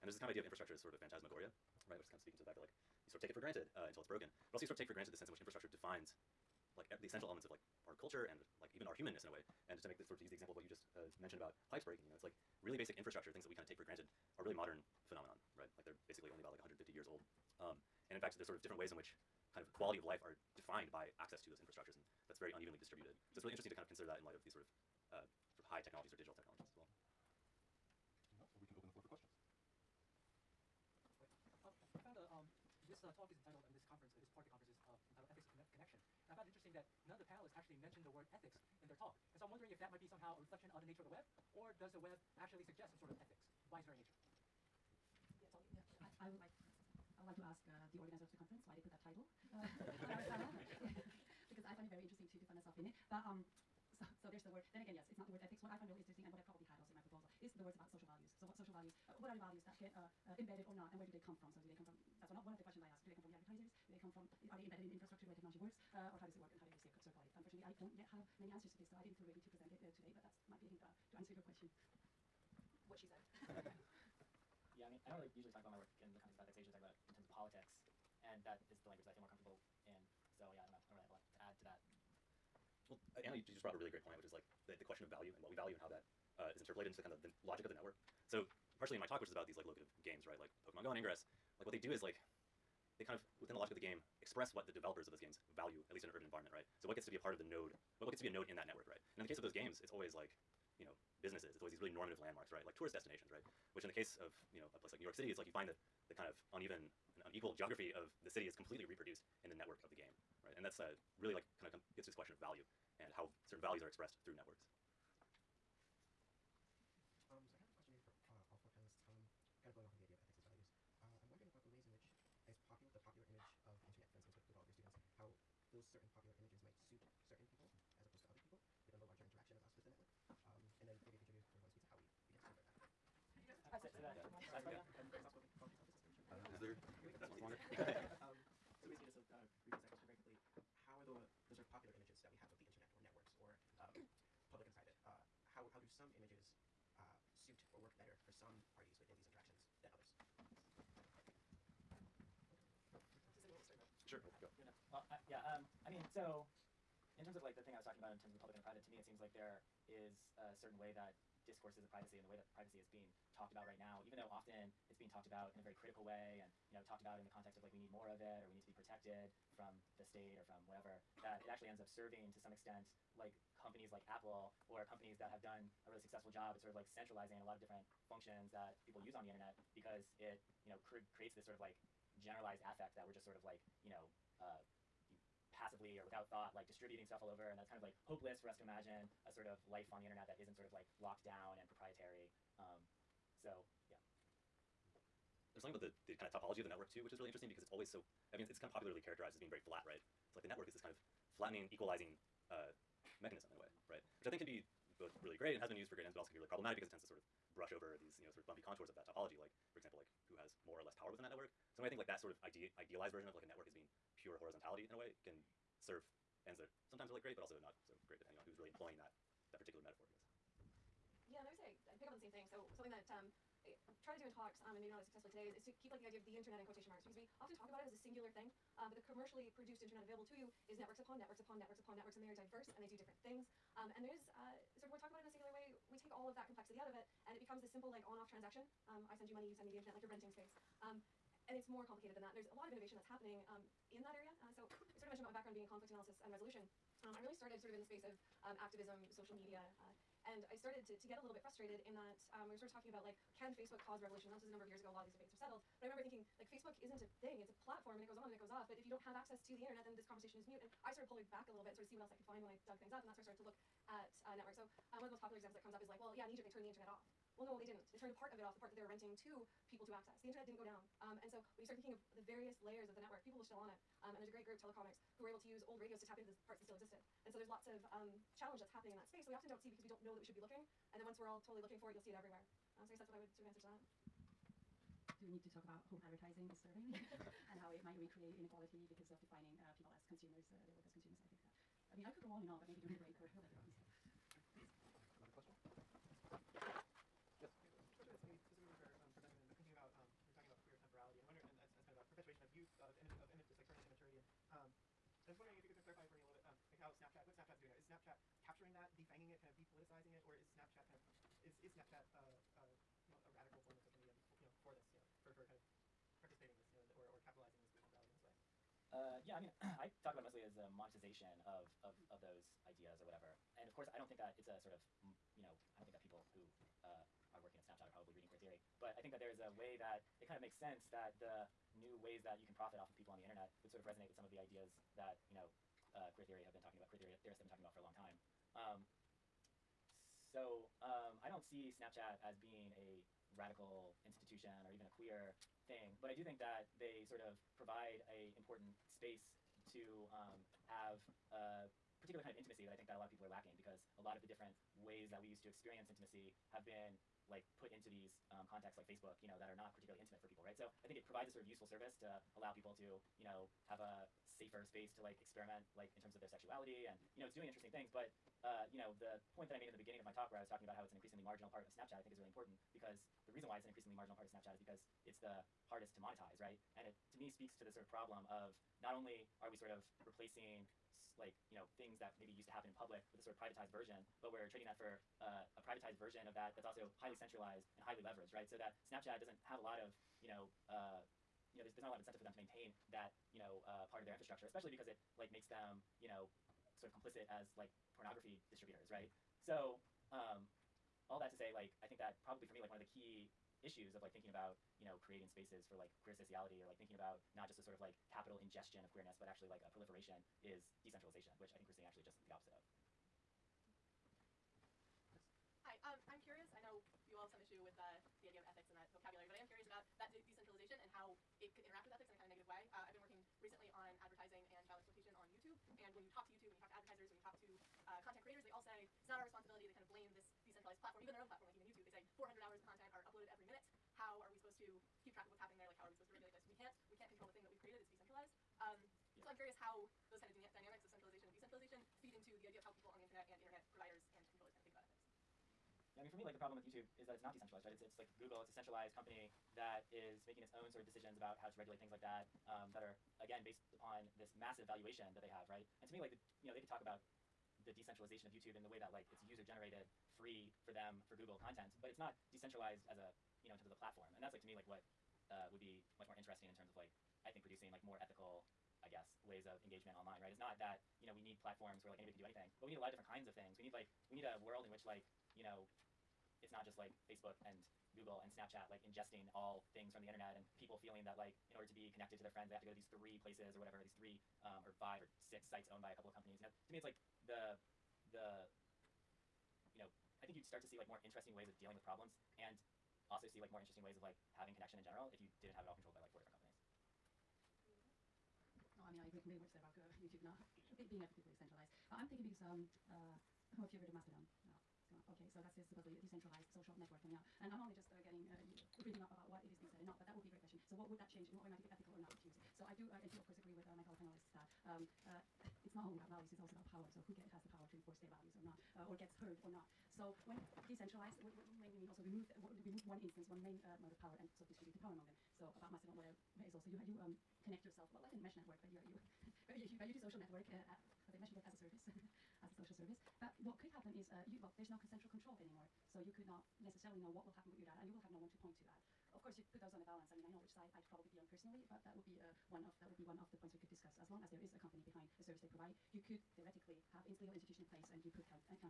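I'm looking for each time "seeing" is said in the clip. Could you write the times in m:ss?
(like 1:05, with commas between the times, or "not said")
6:51.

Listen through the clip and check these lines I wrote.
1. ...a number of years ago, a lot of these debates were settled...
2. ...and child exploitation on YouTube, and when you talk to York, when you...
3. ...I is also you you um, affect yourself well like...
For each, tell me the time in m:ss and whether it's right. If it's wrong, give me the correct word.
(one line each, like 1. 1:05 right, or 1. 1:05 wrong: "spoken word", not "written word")
1. 4:14 right
2. 7:04 wrong: "YouTube", not "York"
3. 8:46 wrong: "connect", not "affect".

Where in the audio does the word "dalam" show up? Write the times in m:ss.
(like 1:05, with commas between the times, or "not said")
not said.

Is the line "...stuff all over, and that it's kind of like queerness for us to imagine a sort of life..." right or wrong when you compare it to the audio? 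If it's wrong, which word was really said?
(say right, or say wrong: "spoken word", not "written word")
wrong: "hopeless", not "queerness".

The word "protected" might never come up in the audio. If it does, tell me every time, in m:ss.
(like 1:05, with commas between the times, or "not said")
2:48.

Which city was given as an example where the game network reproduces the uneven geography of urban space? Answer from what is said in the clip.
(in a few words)
New York City.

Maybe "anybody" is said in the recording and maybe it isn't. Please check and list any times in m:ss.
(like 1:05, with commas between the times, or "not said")
7:51.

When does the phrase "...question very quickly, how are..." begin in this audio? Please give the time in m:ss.
2:19.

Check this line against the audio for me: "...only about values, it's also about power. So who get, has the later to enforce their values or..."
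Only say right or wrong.
wrong.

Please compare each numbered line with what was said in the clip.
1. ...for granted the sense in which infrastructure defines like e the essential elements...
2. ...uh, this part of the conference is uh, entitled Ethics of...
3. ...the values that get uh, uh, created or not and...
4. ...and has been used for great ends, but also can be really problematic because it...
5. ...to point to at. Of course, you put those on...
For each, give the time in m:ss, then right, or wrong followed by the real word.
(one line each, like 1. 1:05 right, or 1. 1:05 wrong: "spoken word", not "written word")
1. 0:04 right
2. 0:34 right
3. 0:59 wrong: "embedded", not "created"
4. 3:25 right
5. 8:58 right.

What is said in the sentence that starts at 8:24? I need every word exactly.
Uh, okay, so that's this supposedly decentralized social network coming up.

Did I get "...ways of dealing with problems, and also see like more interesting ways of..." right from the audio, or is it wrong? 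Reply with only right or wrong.
right.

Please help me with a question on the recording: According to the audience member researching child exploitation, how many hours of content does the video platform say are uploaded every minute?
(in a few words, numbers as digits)
400.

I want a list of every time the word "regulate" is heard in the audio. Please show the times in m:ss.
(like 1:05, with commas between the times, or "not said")
7:16, 7:31.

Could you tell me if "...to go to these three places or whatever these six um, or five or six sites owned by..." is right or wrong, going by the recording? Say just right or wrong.
wrong.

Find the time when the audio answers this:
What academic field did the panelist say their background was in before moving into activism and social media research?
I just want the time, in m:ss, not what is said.
4:05.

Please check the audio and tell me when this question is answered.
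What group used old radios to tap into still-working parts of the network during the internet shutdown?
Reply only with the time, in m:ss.
4:34.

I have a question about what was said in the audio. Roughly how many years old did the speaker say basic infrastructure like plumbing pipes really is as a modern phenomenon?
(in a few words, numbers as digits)
150.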